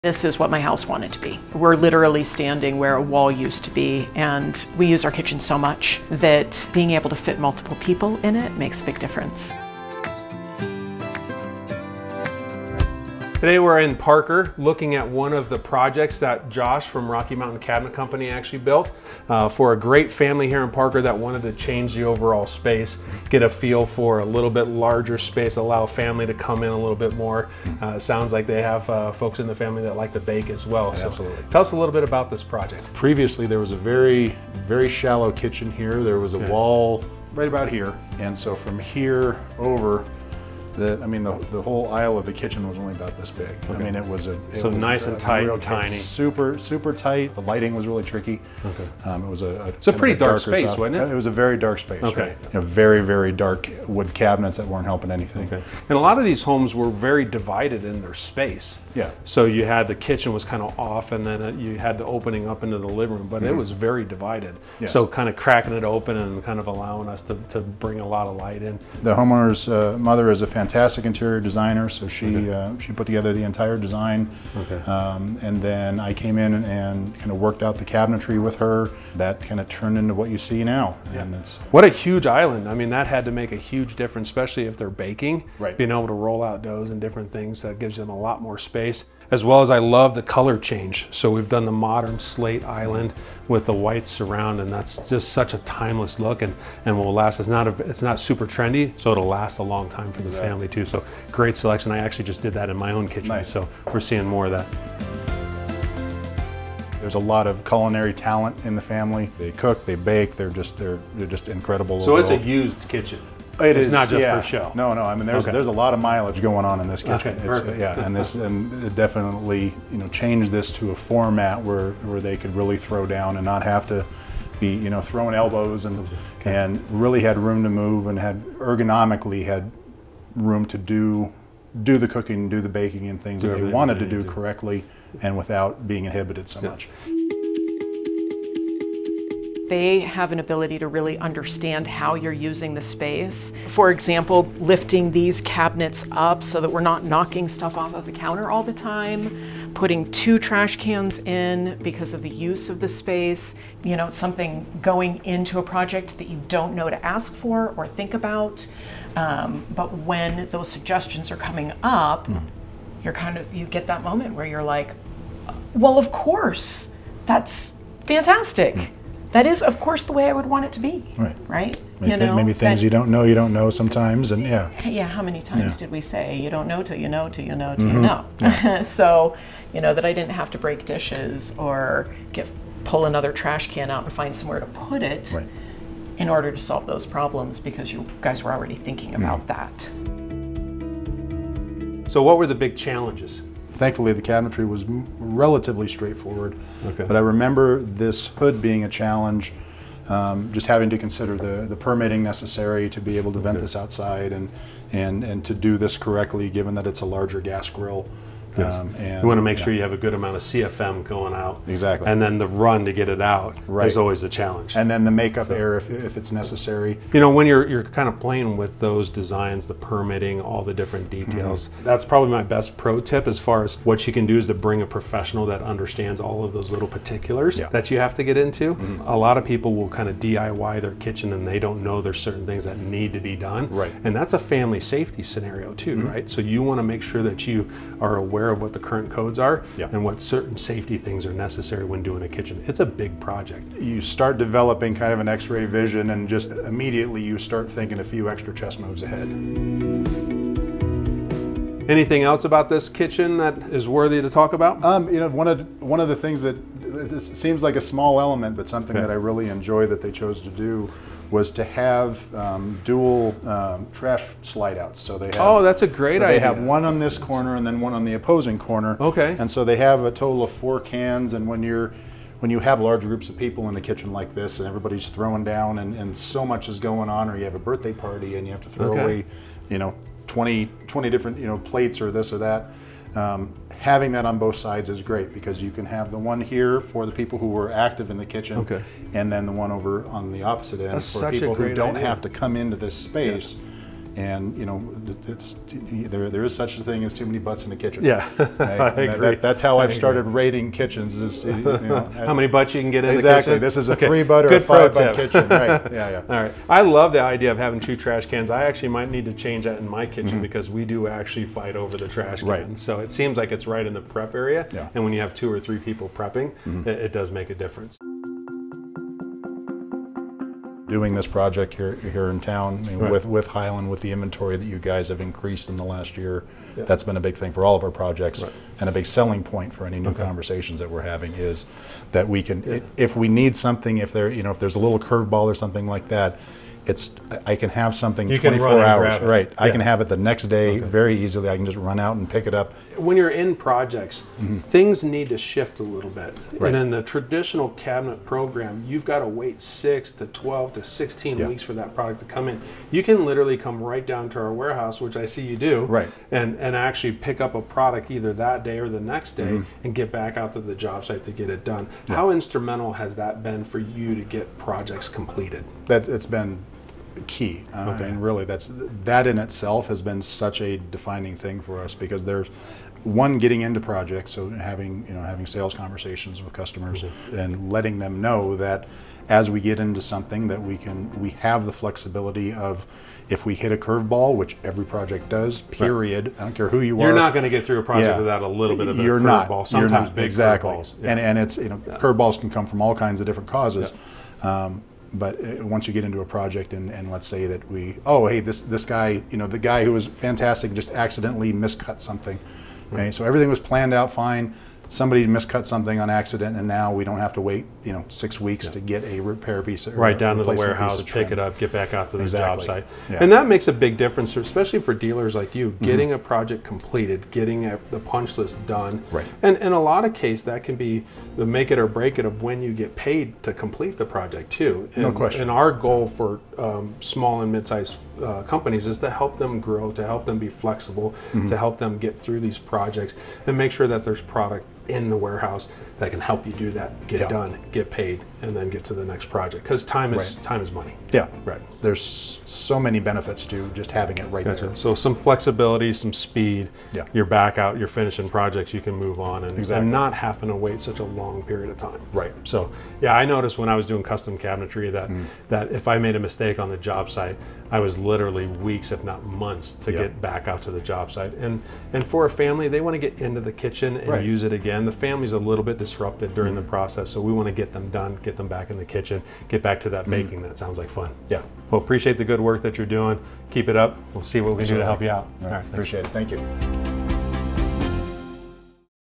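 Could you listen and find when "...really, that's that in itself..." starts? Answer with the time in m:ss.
6:08.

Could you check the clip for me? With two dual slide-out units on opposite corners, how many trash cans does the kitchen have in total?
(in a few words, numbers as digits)
4.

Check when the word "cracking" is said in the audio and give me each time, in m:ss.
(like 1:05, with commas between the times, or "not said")
1:05.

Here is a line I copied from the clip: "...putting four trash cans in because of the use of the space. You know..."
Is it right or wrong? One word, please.
wrong.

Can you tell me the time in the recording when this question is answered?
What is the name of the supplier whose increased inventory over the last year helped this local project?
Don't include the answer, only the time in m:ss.
5:23.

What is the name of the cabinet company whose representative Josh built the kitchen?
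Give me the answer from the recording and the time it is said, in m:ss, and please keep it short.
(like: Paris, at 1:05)
Rocky Mountain Cabinet Company, at 0:17.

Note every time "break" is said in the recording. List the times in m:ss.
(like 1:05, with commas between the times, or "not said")
3:00, 7:01.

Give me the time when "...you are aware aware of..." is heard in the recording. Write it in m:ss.
3:57.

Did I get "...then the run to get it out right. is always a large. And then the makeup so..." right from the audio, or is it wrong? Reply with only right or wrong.
wrong.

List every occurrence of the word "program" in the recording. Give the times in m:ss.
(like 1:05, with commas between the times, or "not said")
5:48.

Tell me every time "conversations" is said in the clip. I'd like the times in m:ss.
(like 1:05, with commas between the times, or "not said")
5:30, 6:15.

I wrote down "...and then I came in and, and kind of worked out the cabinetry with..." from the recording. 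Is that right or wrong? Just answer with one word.
right.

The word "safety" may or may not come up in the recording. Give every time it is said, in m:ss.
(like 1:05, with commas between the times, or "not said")
3:54, 4:00.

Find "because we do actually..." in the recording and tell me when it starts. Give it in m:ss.
5:10.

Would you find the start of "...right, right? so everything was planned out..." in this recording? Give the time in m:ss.
6:42.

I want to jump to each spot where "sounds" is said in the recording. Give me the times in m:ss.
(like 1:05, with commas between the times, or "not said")
0:27, 7:50.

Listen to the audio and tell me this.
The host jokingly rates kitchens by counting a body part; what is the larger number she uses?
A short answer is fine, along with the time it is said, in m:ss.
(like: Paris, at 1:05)
5, at 5:04.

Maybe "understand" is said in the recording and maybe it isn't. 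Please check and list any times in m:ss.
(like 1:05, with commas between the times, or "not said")
2:21, 3:45.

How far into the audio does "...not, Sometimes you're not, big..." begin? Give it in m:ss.
6:29.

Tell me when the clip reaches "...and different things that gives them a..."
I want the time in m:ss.
1:26.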